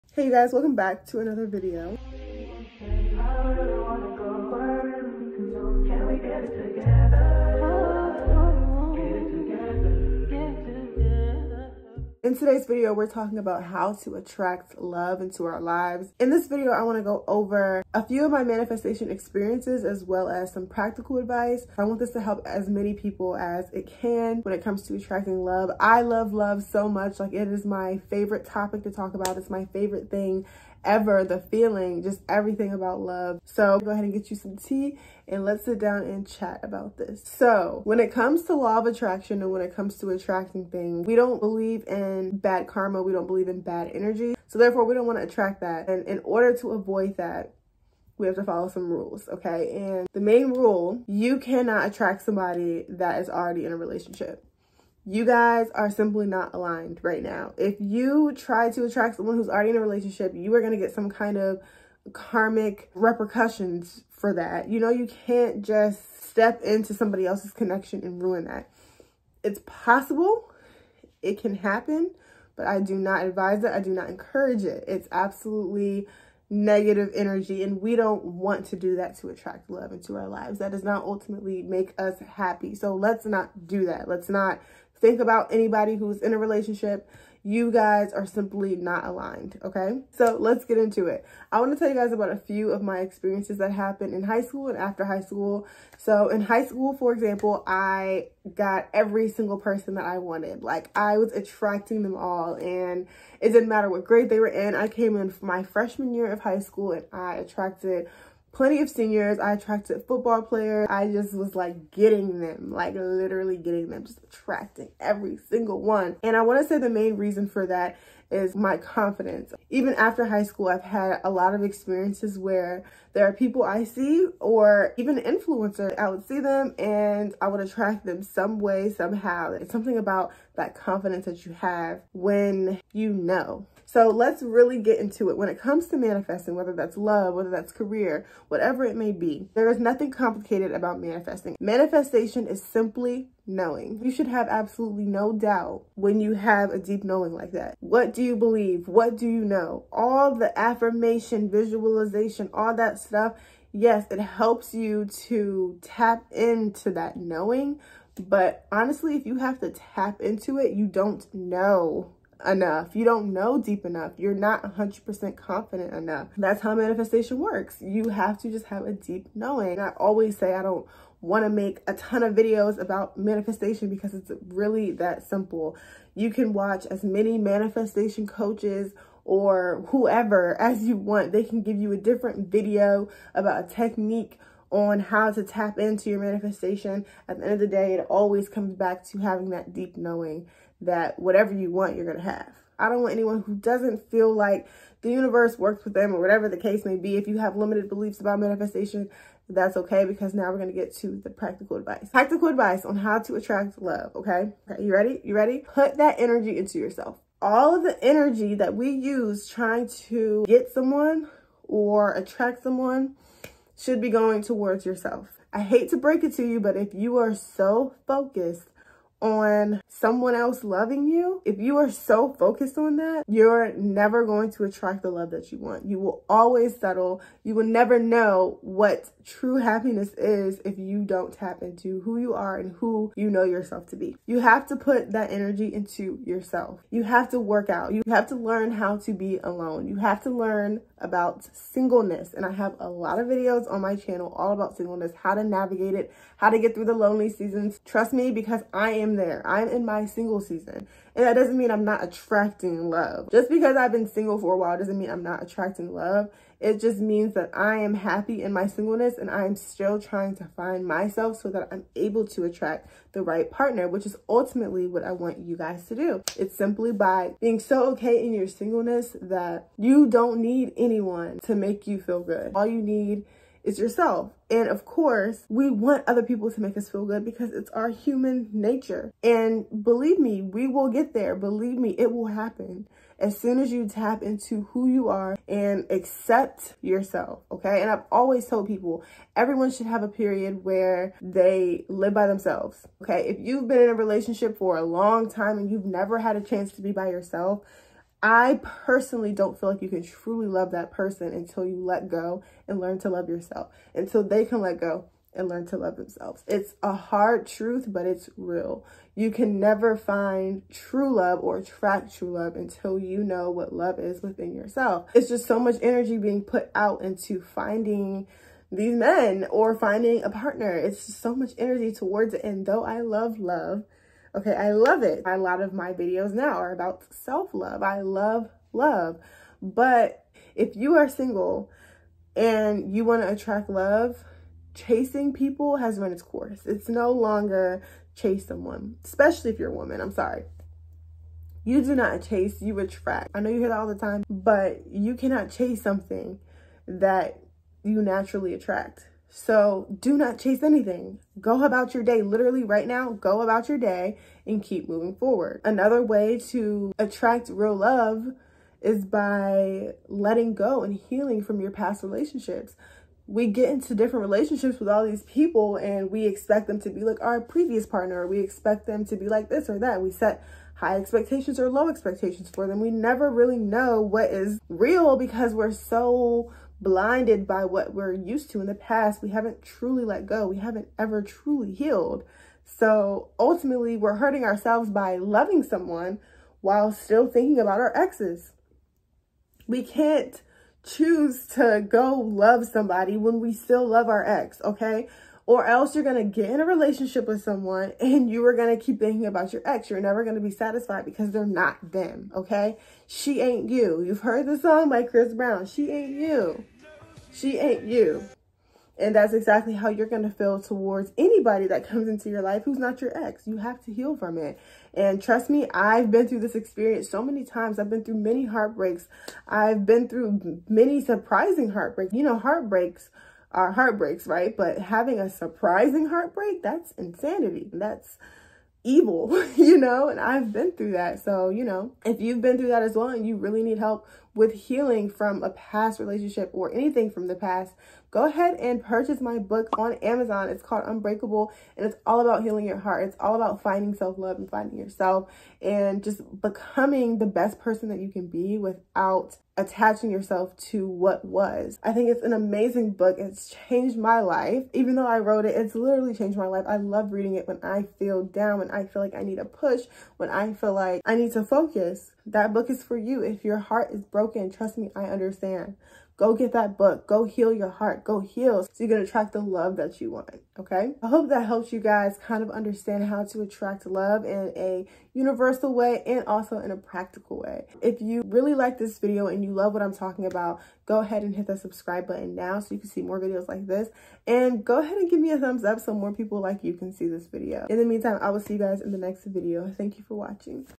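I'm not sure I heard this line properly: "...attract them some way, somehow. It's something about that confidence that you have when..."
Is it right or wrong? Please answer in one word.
right.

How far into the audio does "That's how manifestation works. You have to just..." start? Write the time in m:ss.
2:46.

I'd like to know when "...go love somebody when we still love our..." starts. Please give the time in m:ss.
6:31.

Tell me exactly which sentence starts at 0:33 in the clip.
So go ahead and get you some tea and let's sit down and chat about this.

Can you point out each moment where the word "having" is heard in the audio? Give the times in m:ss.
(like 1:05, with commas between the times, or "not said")
3:09, 7:04.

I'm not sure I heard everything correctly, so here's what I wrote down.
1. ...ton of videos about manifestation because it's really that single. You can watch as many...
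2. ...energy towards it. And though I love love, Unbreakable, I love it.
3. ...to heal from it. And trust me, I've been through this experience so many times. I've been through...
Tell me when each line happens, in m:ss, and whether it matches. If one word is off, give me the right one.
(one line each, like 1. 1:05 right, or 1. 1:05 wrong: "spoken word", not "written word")
1. 2:51 wrong: "simple", not "single"
2. 5:21 wrong: "Okay", not "Unbreakable"
3. 6:53 right.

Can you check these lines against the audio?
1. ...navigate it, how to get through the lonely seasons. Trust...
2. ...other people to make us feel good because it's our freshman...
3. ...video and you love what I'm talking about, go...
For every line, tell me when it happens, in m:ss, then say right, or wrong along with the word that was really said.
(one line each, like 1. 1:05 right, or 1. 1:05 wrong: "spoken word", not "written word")
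1. 4:05 right
2. 4:36 wrong: "human", not "freshman"
3. 7:58 right.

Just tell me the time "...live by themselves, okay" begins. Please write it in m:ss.
4:51.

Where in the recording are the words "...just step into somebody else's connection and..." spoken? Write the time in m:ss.
1:05.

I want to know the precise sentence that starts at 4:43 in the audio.
As soon as you tap into who you are and accept yourself, okay?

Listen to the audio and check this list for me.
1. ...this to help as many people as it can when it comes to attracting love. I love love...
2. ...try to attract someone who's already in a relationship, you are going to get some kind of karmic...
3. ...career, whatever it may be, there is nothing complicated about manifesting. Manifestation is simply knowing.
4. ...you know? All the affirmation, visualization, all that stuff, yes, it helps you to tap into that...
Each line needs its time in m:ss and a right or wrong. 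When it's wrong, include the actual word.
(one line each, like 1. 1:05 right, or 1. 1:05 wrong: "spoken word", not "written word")
1. 0:21 right
2. 0:58 right
3. 2:17 right
4. 2:29 right.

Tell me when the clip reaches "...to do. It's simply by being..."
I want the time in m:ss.
4:25.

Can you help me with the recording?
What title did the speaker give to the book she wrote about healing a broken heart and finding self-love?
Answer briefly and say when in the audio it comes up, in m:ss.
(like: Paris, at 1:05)
Unbreakable, at 7:20.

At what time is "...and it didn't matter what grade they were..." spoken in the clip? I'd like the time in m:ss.
1:42.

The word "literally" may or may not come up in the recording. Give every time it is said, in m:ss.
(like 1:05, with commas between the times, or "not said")
1:52, 5:52, 7:35.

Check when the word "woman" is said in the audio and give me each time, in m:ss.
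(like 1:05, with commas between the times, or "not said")
5:39.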